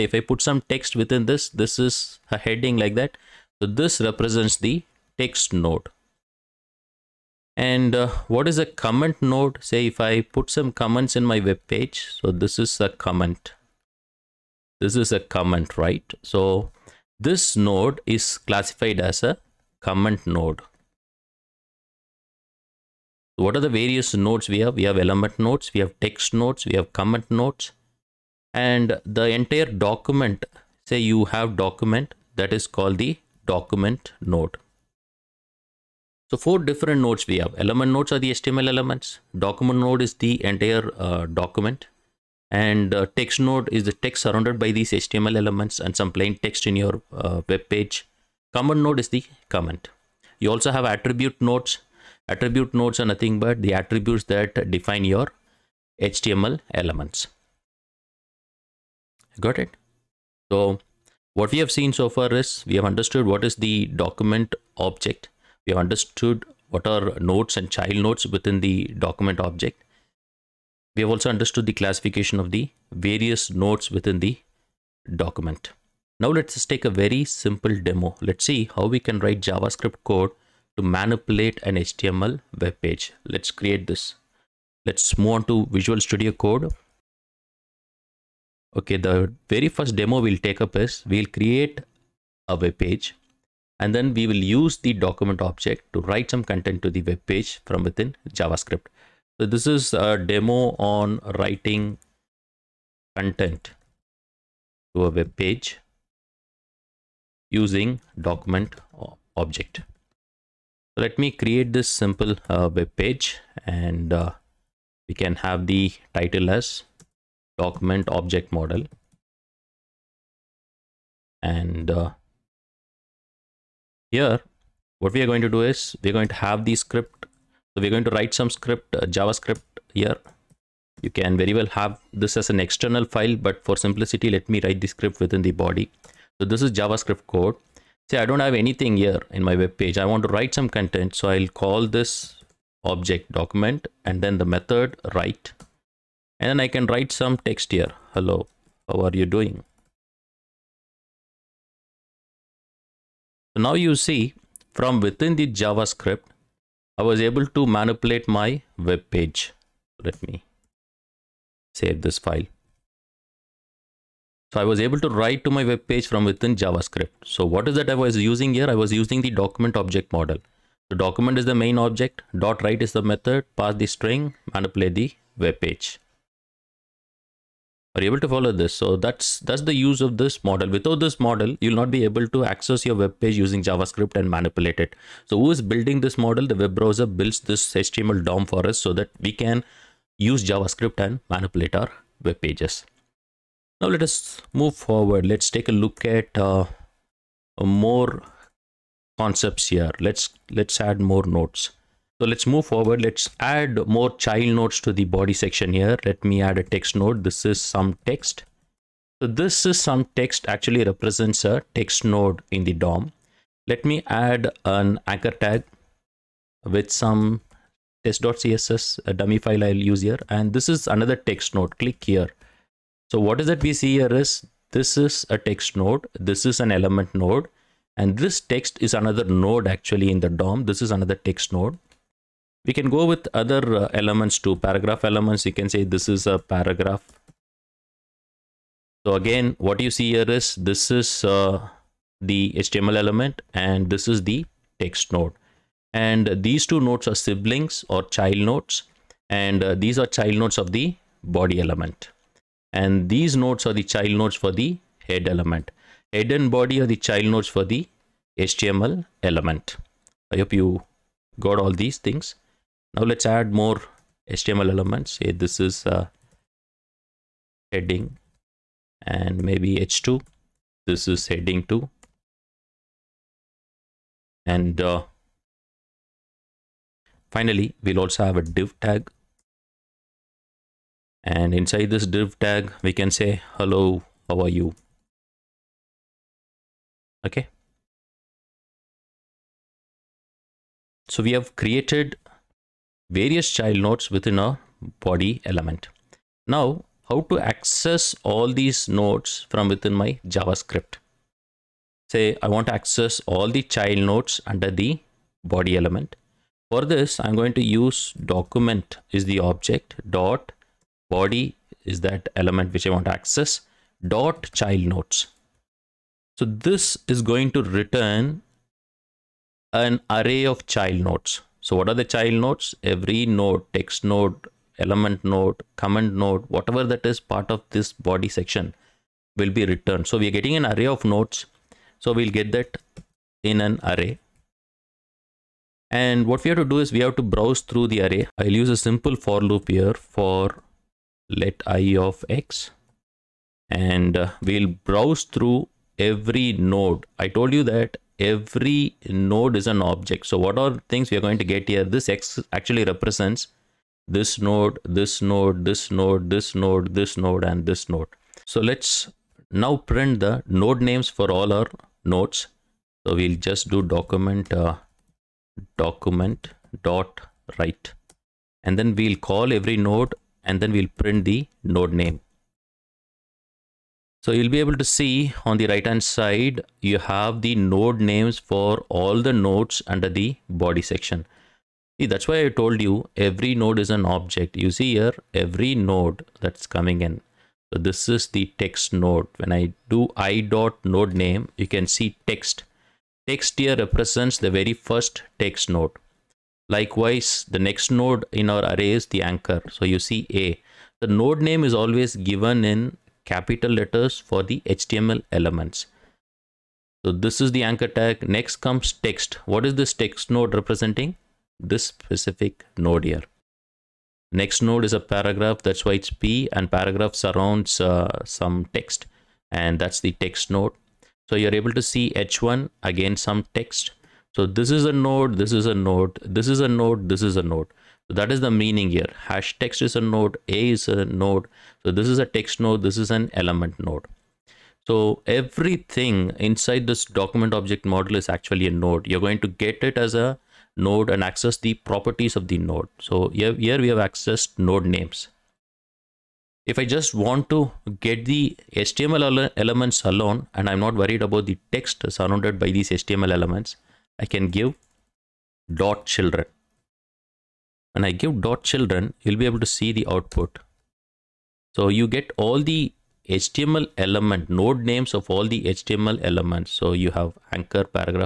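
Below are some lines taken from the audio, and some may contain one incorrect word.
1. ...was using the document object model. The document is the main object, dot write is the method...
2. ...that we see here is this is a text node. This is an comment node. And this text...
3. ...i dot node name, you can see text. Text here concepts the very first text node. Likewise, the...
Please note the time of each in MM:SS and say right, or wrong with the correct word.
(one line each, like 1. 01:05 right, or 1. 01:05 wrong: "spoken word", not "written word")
1. 02:48 right
2. 03:43 wrong: "element", not "comment"
3. 06:30 wrong: "represents", not "concepts".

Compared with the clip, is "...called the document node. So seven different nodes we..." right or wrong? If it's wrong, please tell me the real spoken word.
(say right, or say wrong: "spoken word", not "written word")
wrong: "four", not "seven".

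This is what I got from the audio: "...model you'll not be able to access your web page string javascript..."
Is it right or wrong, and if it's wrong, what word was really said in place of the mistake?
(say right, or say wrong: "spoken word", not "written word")
wrong: "using", not "string".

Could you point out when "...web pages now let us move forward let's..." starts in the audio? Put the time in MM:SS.
03:12.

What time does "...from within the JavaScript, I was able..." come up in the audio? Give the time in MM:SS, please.
02:34.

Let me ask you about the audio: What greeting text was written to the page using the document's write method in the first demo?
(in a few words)
Hello, how are you doing?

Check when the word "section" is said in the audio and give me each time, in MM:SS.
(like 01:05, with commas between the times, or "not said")
03:25, 05:28, 06:20.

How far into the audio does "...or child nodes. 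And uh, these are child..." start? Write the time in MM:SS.
04:07.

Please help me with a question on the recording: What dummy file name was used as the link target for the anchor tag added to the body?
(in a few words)
test.css.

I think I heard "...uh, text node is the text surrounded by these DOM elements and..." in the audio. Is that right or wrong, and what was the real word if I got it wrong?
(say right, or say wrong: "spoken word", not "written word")
wrong: "HTML", not "DOM".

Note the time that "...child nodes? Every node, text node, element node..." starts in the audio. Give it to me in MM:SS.
05:22.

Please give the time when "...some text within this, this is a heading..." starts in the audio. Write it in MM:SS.
00:00.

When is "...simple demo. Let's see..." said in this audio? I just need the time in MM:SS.
01:17.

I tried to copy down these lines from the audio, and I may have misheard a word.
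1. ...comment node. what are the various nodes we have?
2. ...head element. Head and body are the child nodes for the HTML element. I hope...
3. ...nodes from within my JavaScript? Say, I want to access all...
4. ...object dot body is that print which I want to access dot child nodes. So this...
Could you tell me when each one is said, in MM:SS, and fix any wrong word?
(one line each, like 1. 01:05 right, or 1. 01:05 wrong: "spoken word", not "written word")
1. 00:19 right
2. 04:15 right
3. 04:58 right
4. 05:09 wrong: "element", not "print".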